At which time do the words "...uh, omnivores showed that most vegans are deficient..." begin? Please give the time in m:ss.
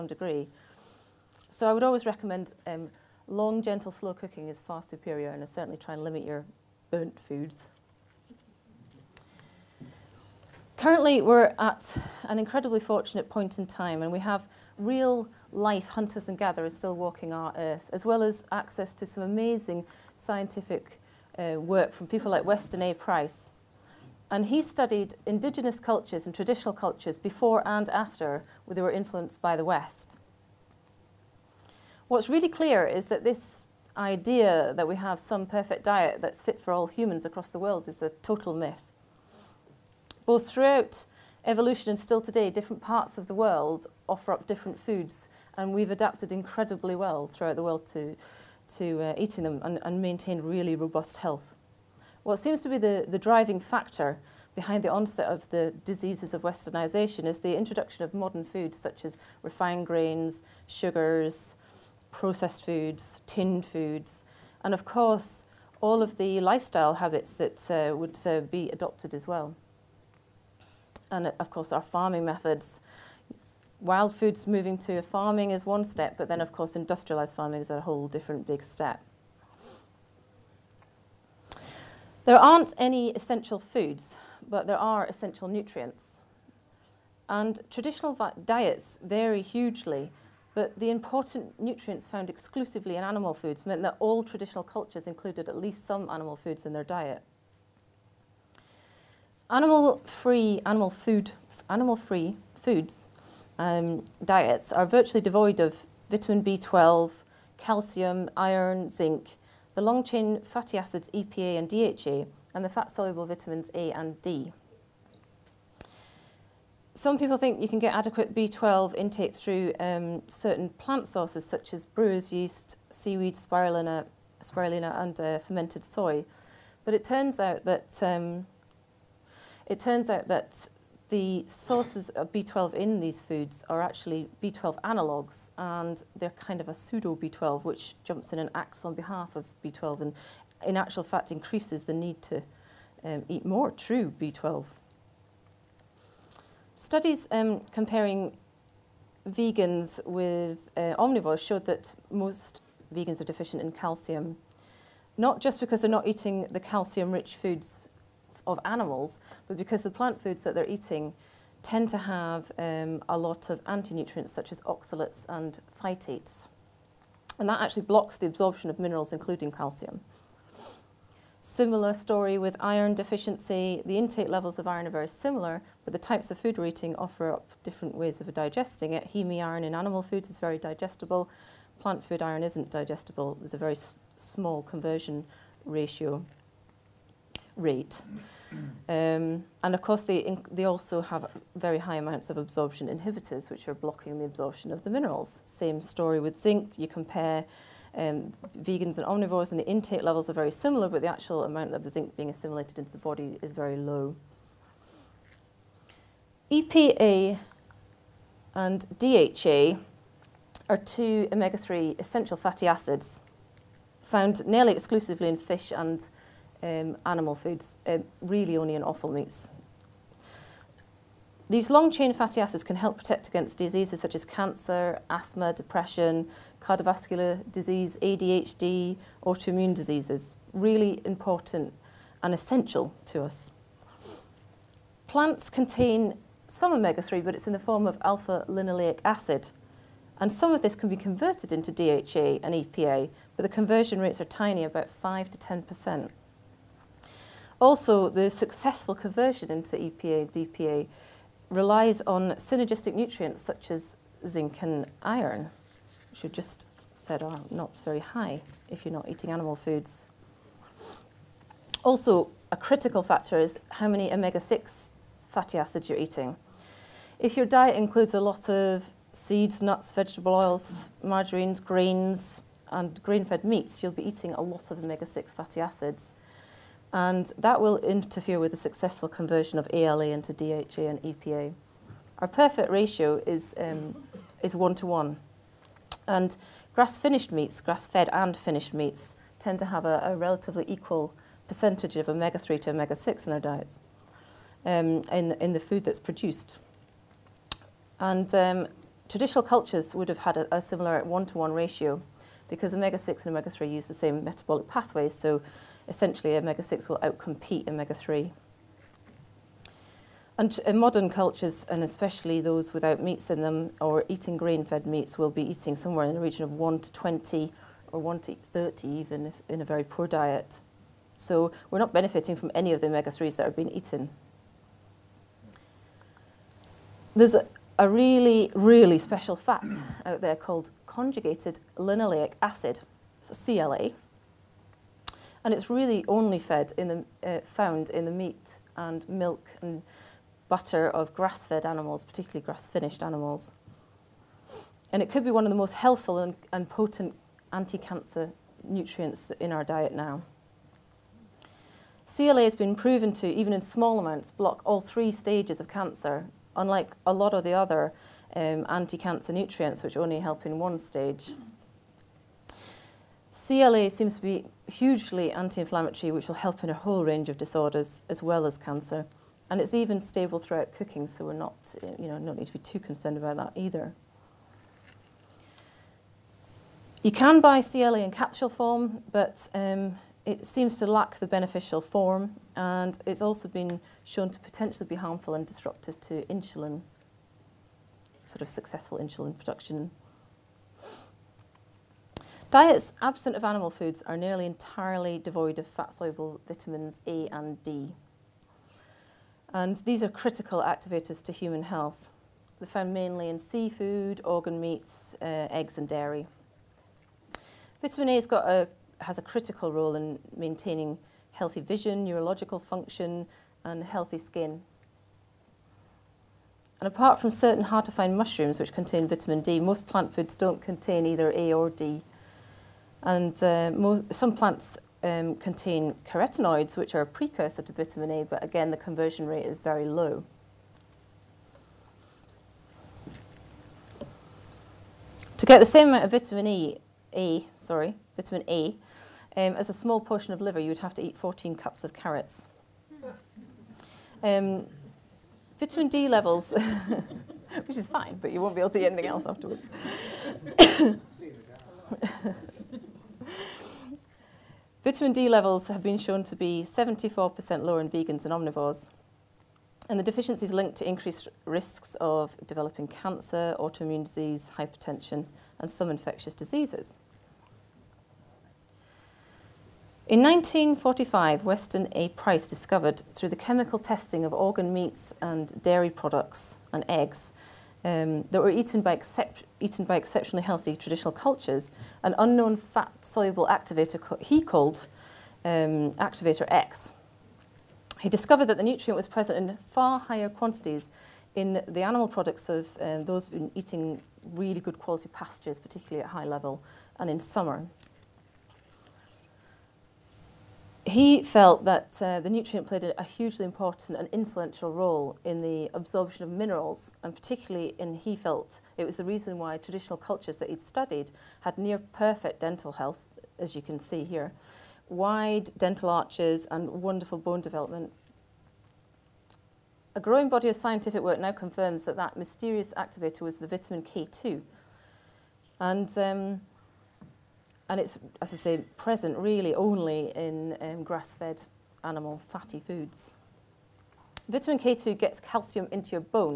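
2:30.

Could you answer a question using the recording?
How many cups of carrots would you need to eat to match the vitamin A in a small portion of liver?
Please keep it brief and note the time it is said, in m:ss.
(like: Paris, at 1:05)
14, at 7:21.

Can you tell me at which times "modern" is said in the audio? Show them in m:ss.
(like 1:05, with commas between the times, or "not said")
0:58, 5:10.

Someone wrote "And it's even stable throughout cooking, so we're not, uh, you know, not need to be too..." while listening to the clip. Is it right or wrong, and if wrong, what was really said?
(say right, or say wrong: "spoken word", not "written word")
right.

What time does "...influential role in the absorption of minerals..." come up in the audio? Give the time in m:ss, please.
8:24.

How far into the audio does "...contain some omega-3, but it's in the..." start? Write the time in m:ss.
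3:55.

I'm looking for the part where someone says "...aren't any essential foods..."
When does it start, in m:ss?
1:22.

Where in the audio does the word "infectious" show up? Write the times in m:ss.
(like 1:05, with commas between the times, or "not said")
7:45.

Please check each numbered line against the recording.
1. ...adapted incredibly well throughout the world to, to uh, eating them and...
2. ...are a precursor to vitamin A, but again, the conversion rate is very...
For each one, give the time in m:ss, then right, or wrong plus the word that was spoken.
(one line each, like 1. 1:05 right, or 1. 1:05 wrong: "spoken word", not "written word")
1. 0:45 right
2. 7:06 right.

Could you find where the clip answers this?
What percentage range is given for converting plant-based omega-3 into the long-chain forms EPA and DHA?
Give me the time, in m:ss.
4:04.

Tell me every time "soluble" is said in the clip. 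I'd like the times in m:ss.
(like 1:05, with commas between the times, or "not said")
1:52, 6:35, 8:02.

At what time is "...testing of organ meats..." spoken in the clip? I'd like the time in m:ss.
7:53.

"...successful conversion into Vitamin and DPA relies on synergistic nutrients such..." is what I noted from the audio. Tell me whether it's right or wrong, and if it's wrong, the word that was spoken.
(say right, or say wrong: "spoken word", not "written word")
wrong: "EPA", not "Vitamin".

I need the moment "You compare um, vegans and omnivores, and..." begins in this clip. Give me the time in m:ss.
3:16.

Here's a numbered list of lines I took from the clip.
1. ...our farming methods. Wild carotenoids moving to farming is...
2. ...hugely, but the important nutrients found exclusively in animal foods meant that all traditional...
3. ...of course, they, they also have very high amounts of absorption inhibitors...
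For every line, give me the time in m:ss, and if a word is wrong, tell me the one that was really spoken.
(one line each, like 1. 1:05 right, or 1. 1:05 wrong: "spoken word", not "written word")
1. 1:11 wrong: "foods", not "carotenoids"
2. 1:29 right
3. 3:09 right.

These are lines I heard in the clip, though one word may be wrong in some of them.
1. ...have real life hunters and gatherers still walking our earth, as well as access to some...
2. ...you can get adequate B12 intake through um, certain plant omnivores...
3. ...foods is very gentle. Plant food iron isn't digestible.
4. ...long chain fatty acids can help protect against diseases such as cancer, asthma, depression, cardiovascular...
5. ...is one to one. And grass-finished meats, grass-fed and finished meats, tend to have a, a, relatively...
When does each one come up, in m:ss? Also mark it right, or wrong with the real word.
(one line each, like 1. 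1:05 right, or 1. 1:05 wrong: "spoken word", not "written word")
1. 0:14 right
2. 1:57 wrong: "sources", not "omnivores"
3. 3:00 wrong: "digestible", not "gentle"
4. 3:41 right
5. 4:44 right.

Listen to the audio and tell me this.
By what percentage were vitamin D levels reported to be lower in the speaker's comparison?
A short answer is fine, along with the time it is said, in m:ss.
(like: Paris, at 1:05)
74%, at 7:36.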